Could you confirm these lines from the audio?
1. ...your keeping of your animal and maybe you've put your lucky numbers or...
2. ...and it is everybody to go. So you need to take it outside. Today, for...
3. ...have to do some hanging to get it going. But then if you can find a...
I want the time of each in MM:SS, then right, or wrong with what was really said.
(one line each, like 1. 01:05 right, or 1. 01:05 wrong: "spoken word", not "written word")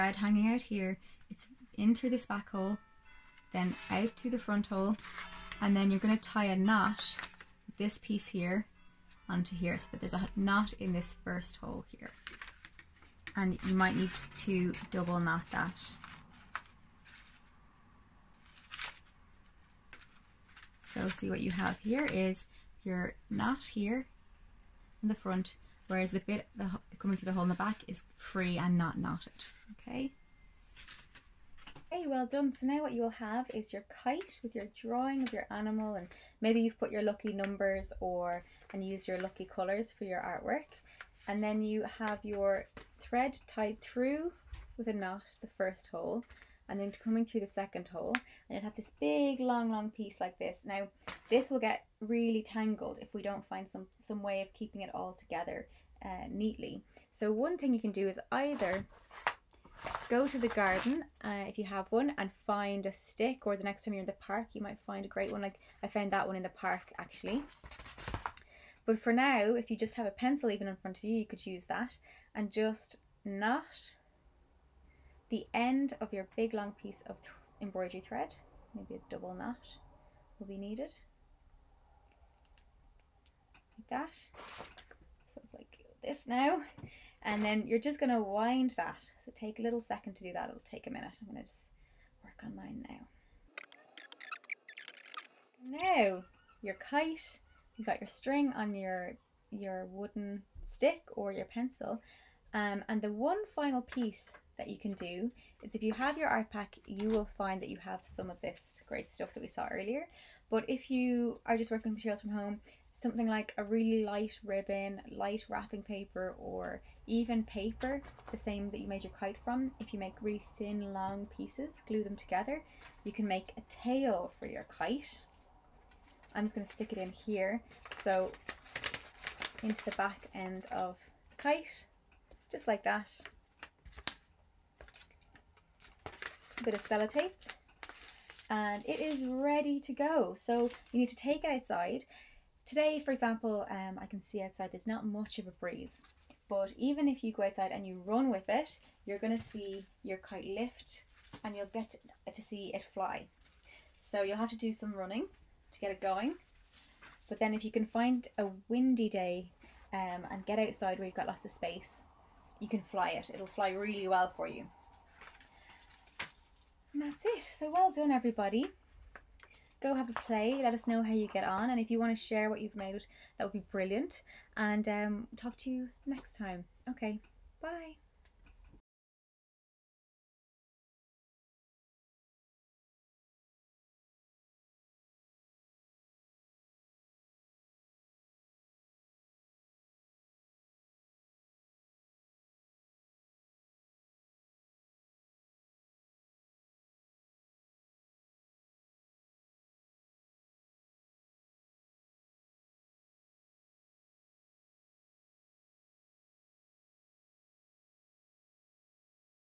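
1. 00:34 wrong: "drawing", not "keeping"
2. 02:18 wrong: "ready", not "everybody"
3. 02:34 wrong: "running", not "hanging".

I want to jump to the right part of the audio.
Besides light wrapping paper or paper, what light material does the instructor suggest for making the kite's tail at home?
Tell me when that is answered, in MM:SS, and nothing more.
01:54.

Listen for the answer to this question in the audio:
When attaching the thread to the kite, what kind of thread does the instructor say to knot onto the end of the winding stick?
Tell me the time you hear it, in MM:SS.
01:17.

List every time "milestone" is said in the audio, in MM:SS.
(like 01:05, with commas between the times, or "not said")
not said.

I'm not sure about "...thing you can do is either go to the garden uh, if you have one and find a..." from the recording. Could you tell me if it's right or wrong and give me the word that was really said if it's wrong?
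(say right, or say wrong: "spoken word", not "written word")
right.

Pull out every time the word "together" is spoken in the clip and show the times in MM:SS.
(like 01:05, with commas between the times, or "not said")
00:55, 02:02.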